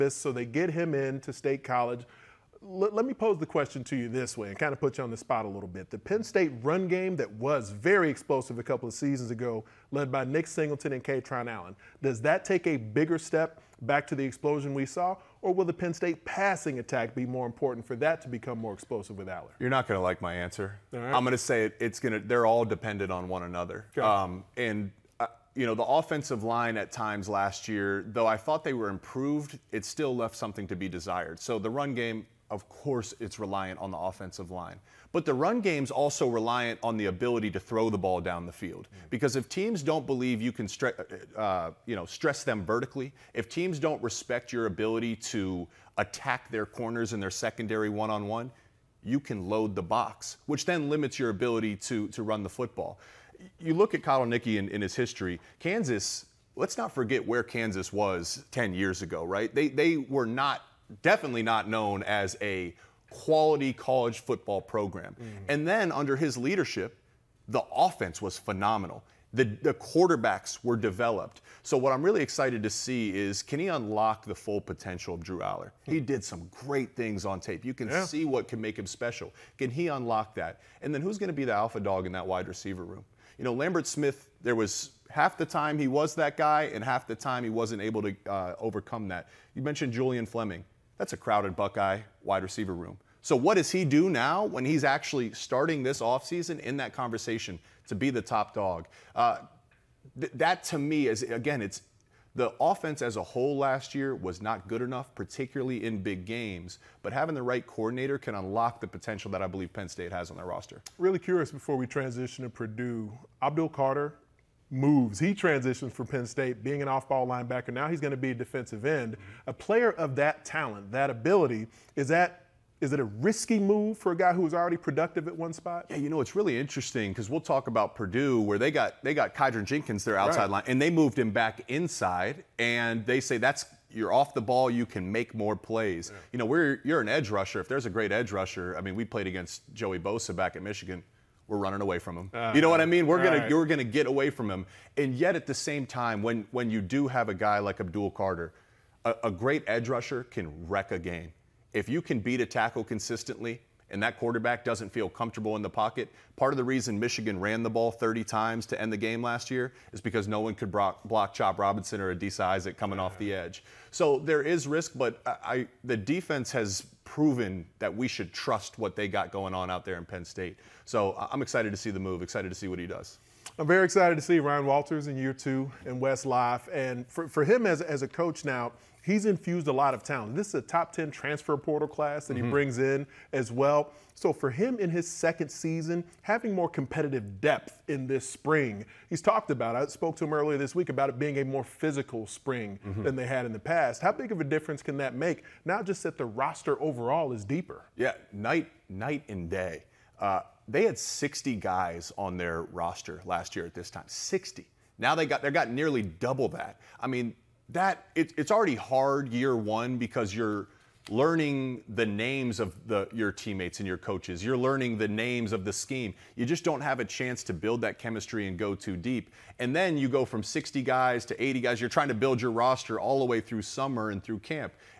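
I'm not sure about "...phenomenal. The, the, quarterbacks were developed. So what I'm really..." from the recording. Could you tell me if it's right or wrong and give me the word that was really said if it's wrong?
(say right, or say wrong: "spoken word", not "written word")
right.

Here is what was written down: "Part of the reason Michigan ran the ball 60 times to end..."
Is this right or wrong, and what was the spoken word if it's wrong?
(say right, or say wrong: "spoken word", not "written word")
wrong: "30", not "60".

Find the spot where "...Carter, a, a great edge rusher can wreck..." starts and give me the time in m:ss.
2:28.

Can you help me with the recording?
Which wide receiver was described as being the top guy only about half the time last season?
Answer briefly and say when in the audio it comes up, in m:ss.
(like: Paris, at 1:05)
Lambert Smith, at 1:23.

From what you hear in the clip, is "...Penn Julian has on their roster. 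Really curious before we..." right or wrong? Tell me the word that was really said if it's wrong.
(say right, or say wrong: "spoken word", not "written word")
wrong: "State", not "Julian".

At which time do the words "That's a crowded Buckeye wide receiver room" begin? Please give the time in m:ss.
1:30.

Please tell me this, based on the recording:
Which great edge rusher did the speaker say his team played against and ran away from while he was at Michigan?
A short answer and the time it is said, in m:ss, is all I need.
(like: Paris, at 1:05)
Joey Bosa, at 2:19.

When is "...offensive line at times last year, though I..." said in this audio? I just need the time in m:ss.
0:25.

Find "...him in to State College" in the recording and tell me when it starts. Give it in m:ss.
0:00.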